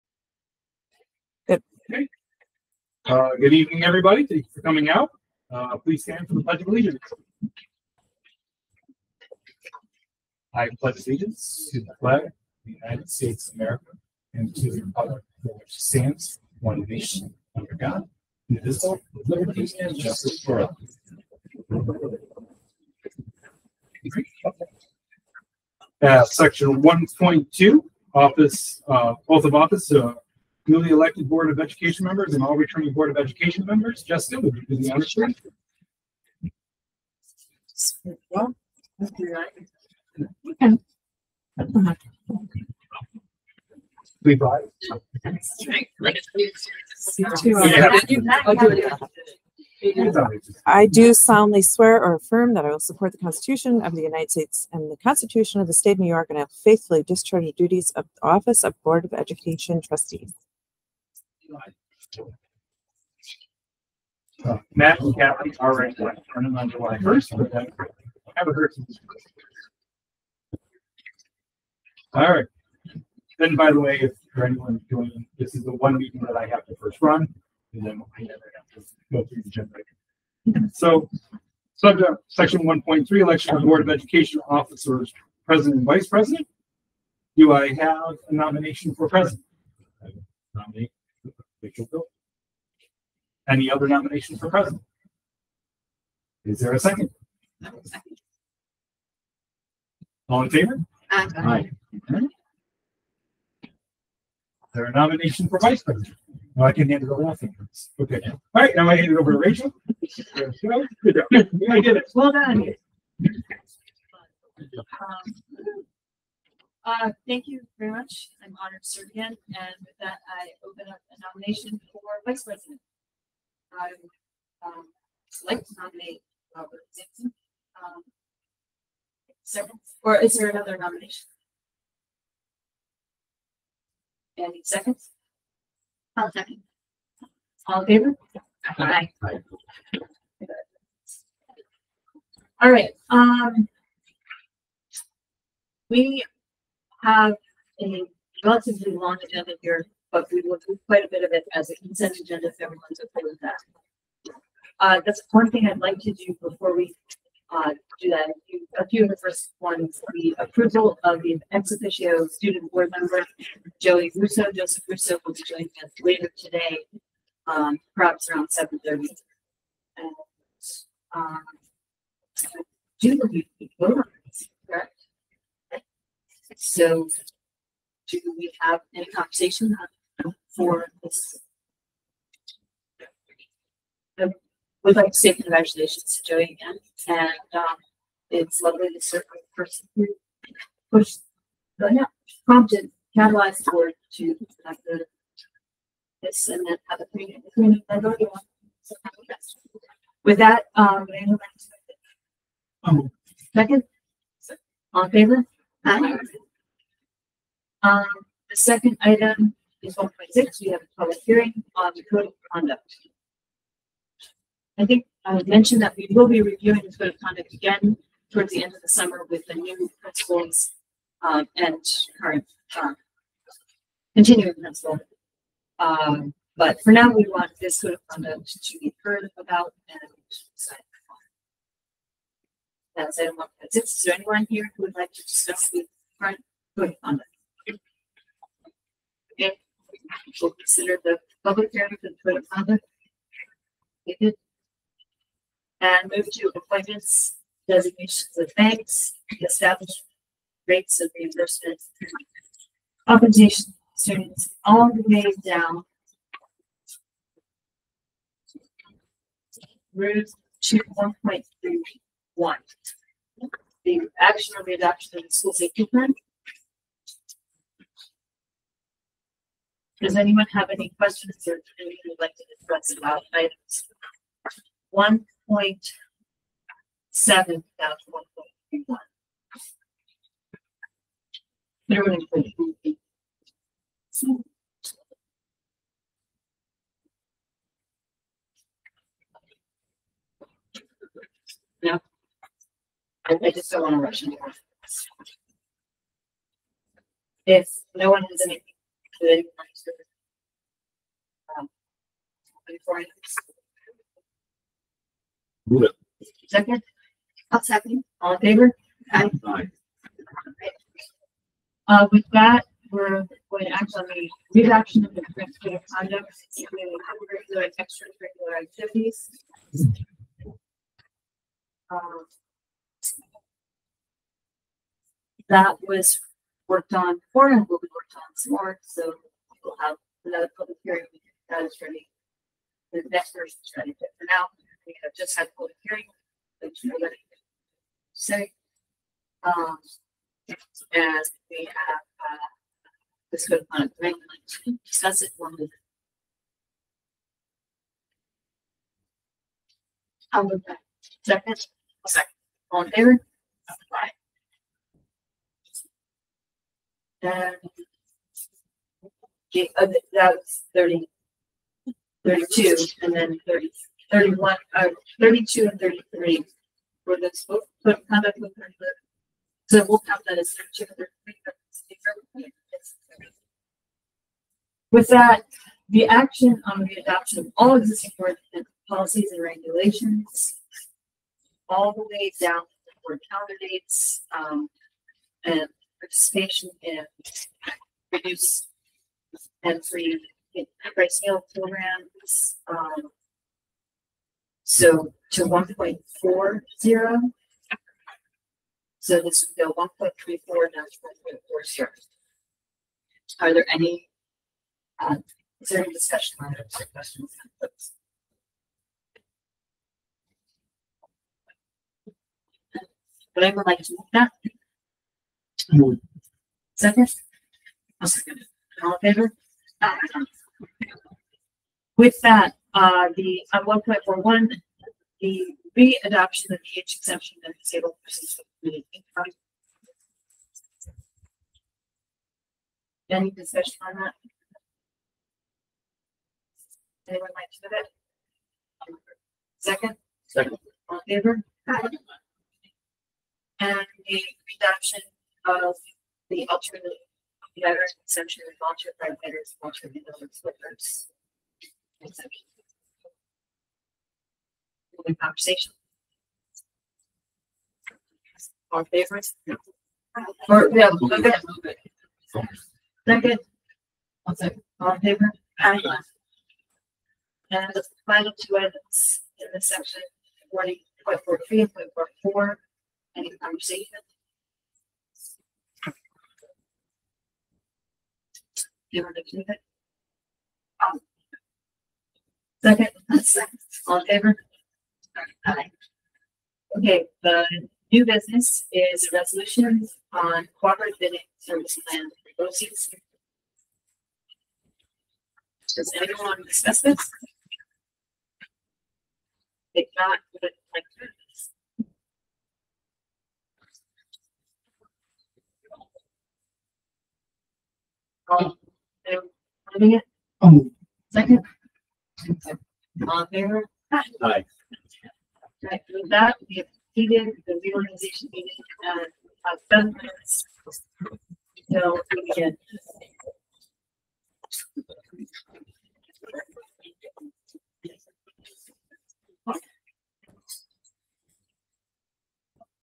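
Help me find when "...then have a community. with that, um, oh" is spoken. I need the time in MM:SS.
03:16.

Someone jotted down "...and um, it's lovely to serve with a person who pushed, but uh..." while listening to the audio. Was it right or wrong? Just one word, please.
right.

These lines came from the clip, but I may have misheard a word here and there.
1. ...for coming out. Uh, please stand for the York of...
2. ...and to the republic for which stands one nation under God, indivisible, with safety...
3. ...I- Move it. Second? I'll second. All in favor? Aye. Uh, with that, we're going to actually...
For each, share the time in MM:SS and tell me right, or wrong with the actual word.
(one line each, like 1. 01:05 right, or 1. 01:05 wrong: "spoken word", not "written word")
1. 00:04 wrong: "Pledge", not "York"
2. 00:14 wrong: "liberty", not "safety"
3. 05:02 right.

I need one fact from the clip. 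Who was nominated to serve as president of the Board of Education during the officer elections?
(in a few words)
Rachel Bill.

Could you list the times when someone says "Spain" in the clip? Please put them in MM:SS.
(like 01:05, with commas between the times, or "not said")
not said.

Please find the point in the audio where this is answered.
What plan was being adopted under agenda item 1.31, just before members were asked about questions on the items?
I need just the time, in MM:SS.
04:25.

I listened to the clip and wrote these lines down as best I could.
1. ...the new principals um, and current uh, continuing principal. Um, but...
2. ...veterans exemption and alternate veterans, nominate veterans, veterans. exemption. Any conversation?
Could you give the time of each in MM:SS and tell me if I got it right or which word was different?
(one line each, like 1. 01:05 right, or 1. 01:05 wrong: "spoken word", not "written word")
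1. 03:39 right
2. 07:27 wrong: "alternate", not "nominate".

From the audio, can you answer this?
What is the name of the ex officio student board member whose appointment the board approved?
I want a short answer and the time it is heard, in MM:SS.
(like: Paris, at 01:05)
Joey Russo, at 02:43.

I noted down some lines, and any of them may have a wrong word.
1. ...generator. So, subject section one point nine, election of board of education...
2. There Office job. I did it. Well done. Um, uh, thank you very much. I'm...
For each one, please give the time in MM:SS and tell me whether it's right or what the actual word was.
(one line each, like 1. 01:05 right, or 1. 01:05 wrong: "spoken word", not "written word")
1. 01:19 wrong: "three", not "nine"
2. 01:50 wrong: "Good", not "Office".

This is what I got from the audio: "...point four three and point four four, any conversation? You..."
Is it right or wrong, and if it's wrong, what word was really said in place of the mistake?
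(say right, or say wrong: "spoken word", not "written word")
right.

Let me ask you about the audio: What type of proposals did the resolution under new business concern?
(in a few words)
cooperative bidding service plan.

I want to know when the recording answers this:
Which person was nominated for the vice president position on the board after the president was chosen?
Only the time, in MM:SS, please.
02:06.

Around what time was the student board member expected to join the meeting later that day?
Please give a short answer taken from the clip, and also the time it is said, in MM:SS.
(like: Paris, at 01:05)
7:30, at 02:48.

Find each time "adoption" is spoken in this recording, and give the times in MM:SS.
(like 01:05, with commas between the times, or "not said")
04:24, 06:16, 07:05, 07:24.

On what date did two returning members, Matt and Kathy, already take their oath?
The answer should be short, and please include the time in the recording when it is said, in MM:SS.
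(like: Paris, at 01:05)
July 1, at 01:06.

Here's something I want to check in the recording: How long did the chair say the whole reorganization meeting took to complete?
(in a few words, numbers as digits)
7 minutes.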